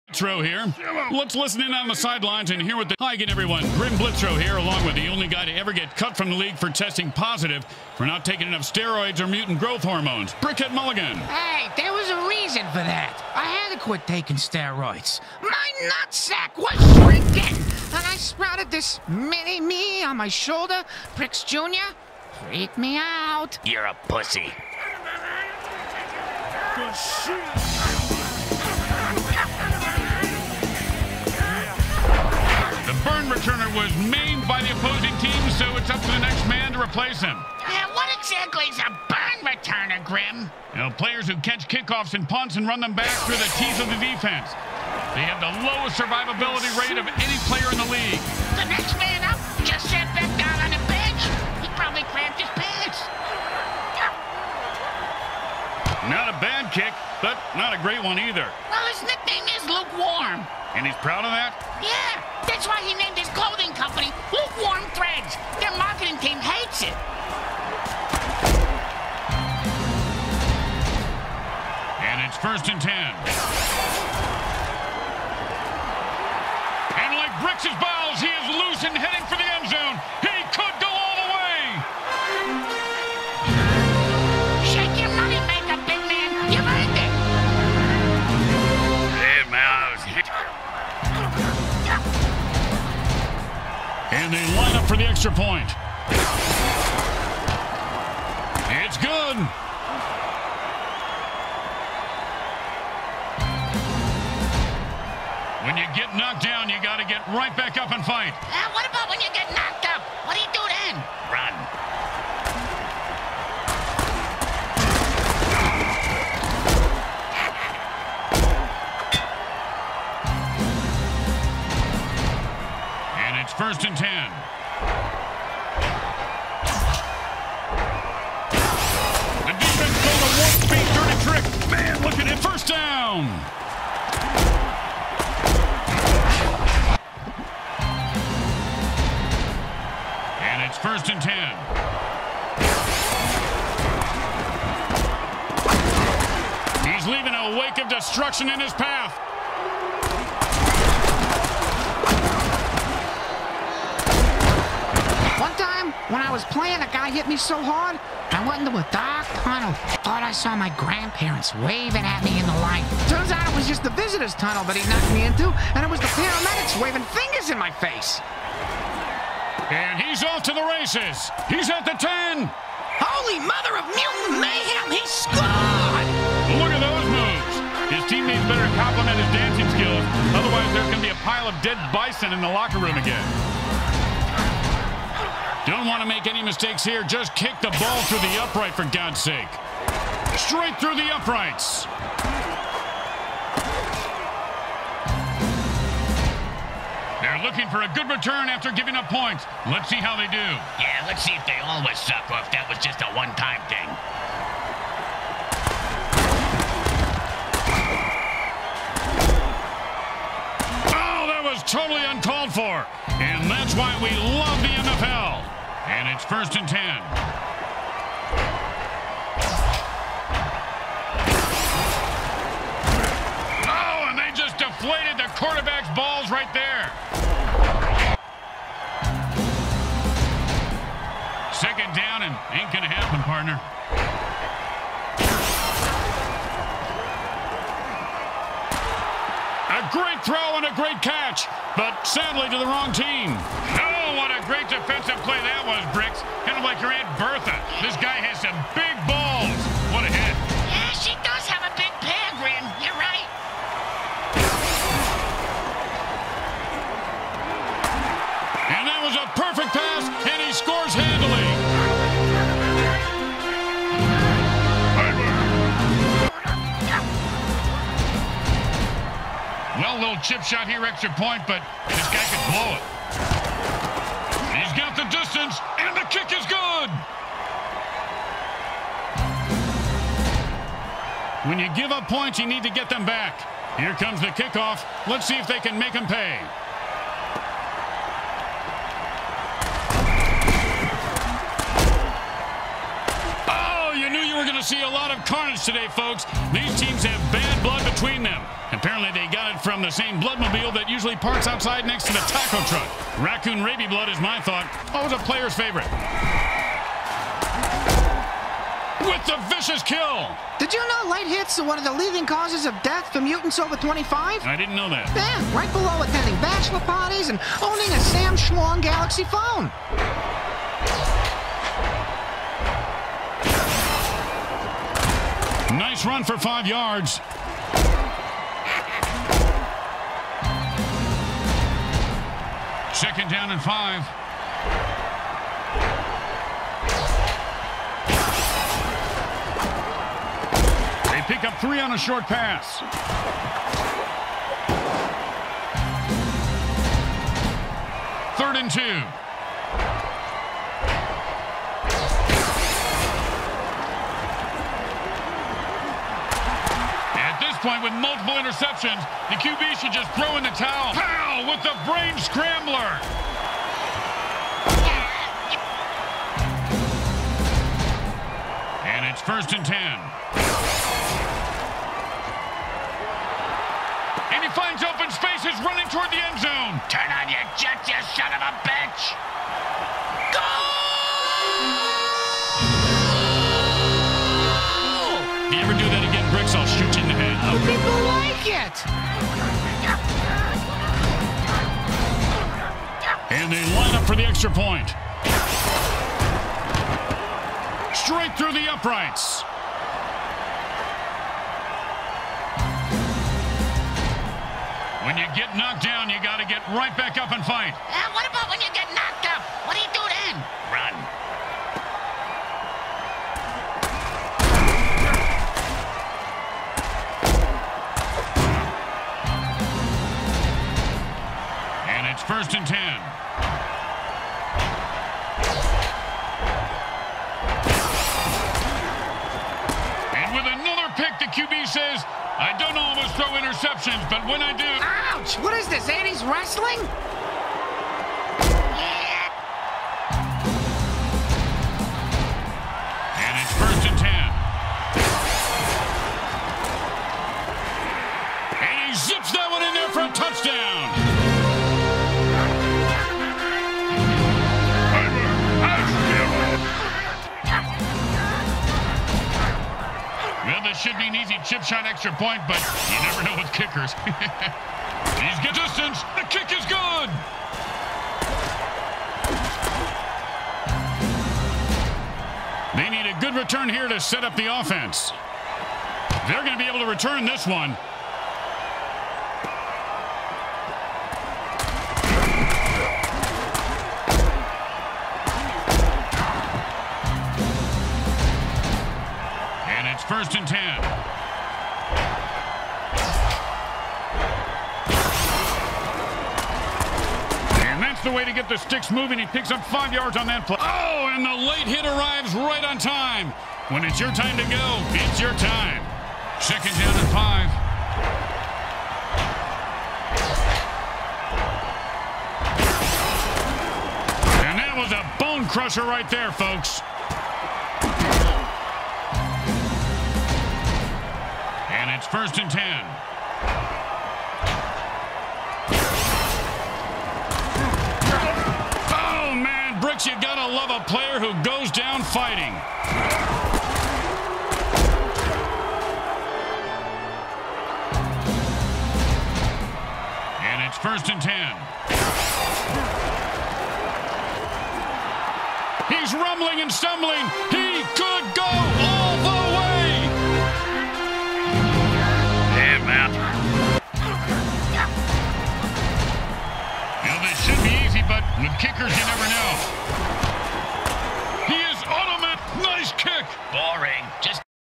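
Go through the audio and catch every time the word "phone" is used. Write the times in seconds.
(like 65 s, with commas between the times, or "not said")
319 s.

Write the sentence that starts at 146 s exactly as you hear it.
He's leaving a wake of destruction in his path.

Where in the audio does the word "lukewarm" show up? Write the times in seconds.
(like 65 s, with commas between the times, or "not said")
59 s, 64 s.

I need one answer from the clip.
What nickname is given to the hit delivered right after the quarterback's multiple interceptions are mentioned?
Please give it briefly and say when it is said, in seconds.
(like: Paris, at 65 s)
Brain scrambler, at 361 s.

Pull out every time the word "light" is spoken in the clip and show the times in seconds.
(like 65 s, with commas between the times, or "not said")
162 s, 311 s.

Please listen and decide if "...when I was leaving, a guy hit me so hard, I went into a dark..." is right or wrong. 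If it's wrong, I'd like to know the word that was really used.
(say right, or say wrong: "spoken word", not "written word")
wrong: "playing", not "leaving".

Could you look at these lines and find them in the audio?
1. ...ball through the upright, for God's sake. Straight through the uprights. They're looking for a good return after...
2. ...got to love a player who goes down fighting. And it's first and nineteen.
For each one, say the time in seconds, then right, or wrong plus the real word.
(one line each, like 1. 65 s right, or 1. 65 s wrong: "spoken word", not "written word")
1. 187 s right
2. 530 s wrong: "ten", not "nineteen".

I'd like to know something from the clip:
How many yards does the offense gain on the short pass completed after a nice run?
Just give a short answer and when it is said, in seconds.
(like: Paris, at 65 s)
3, at 341 s.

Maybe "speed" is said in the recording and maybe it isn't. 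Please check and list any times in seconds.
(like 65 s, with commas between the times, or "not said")
130 s.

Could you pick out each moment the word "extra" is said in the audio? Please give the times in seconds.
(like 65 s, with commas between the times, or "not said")
95 s, 270 s, 394 s, 461 s.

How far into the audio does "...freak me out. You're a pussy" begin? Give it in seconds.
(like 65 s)
22 s.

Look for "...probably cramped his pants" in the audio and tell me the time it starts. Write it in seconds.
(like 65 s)
51 s.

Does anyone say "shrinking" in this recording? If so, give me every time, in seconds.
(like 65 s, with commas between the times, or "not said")
16 s.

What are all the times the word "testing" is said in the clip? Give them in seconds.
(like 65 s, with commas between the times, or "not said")
6 s.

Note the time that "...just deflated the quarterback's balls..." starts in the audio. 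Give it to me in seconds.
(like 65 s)
224 s.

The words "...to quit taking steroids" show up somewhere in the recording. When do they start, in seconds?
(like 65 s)
13 s.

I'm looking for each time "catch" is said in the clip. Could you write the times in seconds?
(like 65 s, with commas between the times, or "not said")
41 s, 241 s.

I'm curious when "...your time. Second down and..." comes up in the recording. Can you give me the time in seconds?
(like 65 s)
505 s.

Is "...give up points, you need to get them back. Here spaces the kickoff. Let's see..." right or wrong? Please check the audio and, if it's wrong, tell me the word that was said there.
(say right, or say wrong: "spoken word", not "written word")
wrong: "comes", not "spaces".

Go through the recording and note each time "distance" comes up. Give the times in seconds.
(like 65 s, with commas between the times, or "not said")
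275 s, 465 s.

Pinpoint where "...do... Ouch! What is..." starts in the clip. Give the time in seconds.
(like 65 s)
434 s.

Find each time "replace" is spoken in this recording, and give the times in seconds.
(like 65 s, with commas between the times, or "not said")
36 s.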